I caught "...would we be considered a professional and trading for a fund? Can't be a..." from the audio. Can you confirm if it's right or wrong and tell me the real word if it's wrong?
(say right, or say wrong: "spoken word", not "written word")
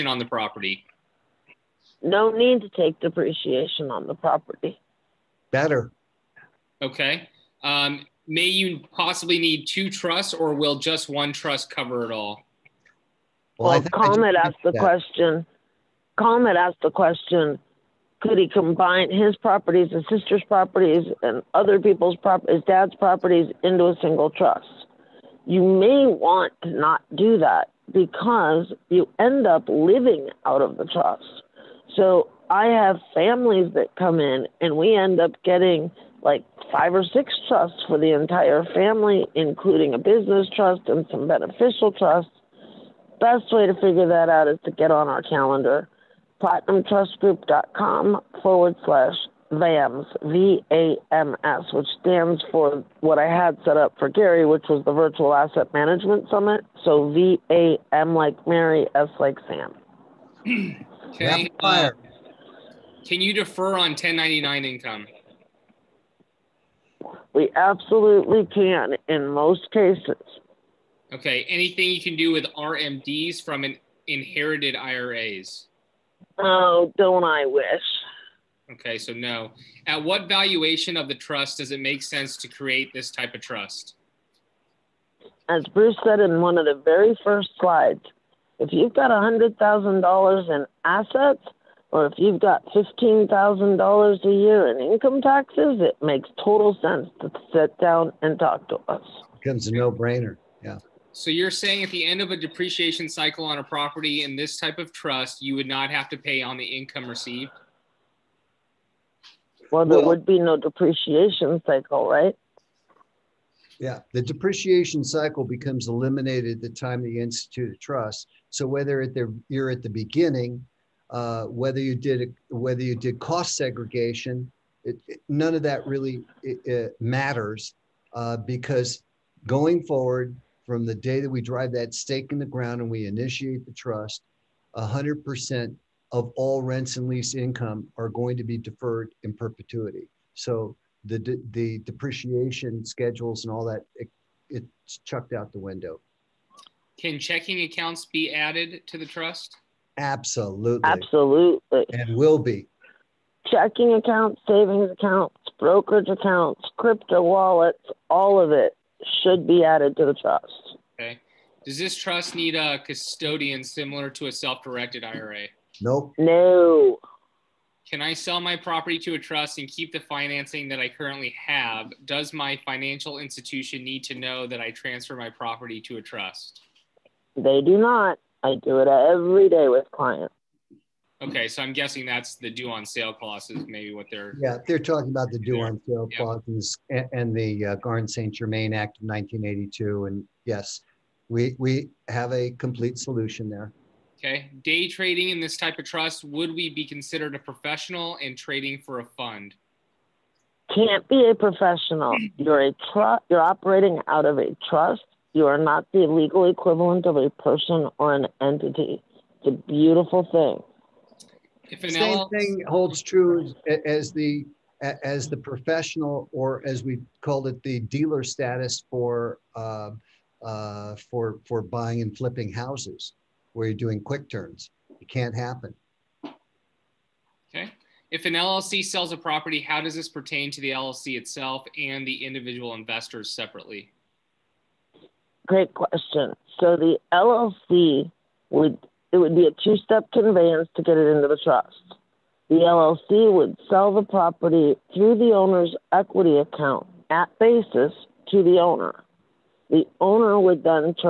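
right.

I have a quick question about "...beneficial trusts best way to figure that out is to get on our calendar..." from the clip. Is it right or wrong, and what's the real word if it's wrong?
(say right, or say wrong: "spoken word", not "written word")
right.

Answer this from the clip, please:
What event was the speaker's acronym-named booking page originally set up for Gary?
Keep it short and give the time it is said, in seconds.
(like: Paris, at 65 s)
Virtual Asset Management Summit, at 54 s.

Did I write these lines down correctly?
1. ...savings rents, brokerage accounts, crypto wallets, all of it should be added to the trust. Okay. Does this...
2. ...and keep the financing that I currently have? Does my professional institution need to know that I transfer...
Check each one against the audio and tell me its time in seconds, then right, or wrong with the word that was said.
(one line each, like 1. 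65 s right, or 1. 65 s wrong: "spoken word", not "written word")
1. 154 s wrong: "accounts", not "rents"
2. 169 s wrong: "financial", not "professional".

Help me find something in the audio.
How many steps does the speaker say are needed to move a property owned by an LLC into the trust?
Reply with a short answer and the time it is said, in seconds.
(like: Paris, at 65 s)
2, at 239 s.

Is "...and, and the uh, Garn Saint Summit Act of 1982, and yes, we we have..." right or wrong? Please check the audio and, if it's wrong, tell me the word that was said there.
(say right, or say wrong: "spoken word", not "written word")
wrong: "Germain", not "Summit".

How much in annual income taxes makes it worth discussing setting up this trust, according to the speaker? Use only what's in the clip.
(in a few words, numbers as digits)
$15,000.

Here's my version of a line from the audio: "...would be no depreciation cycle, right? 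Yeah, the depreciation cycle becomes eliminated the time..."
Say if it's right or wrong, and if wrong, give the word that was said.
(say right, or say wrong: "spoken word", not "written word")
right.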